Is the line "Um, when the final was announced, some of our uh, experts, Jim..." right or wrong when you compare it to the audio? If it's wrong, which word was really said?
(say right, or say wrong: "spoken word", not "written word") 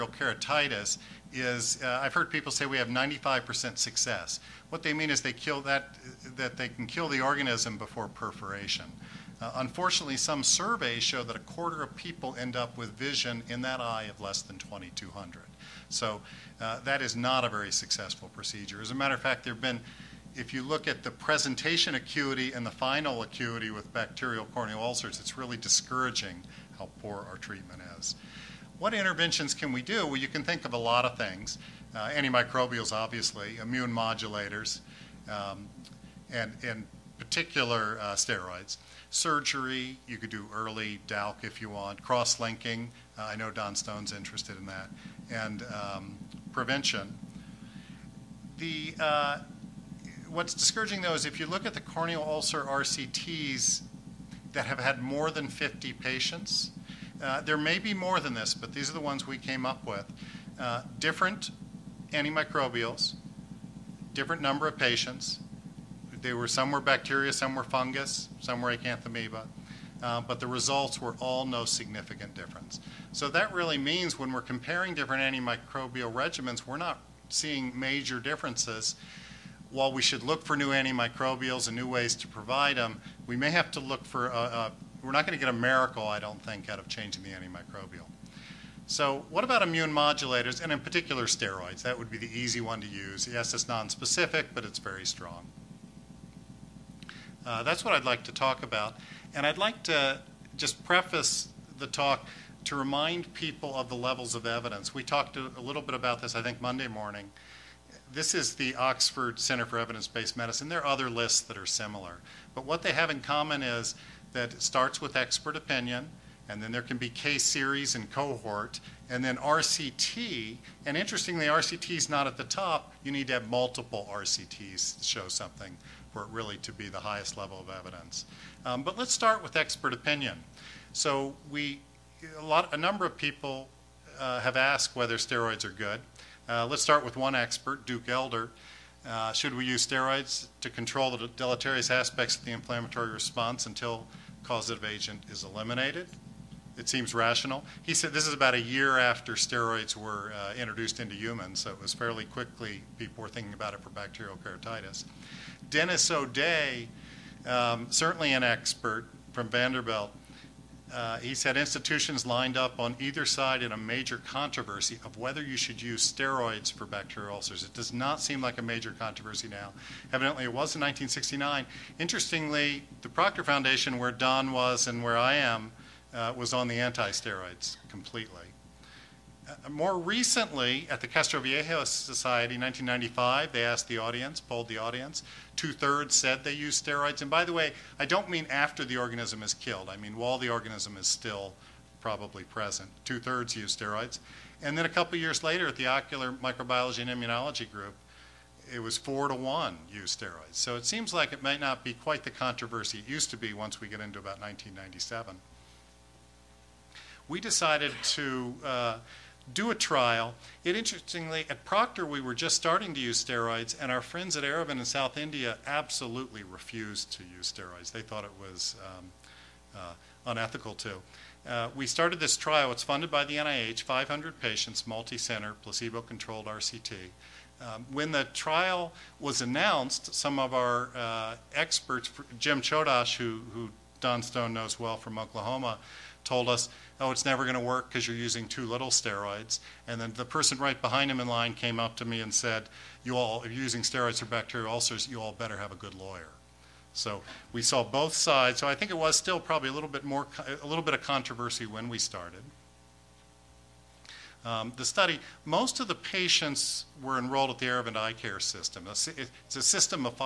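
wrong: "trial", not "final".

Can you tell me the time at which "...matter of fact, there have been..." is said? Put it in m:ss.
0:18.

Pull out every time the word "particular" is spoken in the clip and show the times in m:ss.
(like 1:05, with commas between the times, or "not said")
0:37, 1:30.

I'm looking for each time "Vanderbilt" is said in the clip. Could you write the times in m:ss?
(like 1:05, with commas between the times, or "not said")
2:39.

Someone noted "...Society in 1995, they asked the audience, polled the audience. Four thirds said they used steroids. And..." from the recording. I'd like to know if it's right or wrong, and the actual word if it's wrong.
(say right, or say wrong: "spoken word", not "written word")
wrong: "Two", not "Four".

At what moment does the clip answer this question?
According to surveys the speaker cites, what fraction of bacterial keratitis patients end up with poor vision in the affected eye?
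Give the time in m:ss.
0:11.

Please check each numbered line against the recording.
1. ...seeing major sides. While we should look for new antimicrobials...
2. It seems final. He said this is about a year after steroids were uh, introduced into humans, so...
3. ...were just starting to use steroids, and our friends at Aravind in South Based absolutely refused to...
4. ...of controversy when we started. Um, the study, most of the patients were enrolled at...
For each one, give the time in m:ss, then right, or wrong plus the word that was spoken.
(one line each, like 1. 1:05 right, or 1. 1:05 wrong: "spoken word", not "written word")
1. 1:17 wrong: "differences", not "sides"
2. 2:26 wrong: "rational", not "final"
3. 3:32 wrong: "India", not "Based"
4. 4:10 right.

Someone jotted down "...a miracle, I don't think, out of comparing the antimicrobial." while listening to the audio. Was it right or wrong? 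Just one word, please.
wrong.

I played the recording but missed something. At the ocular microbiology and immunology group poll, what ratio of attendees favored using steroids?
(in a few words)
4 to 1.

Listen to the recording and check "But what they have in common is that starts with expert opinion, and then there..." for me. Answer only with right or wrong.
right.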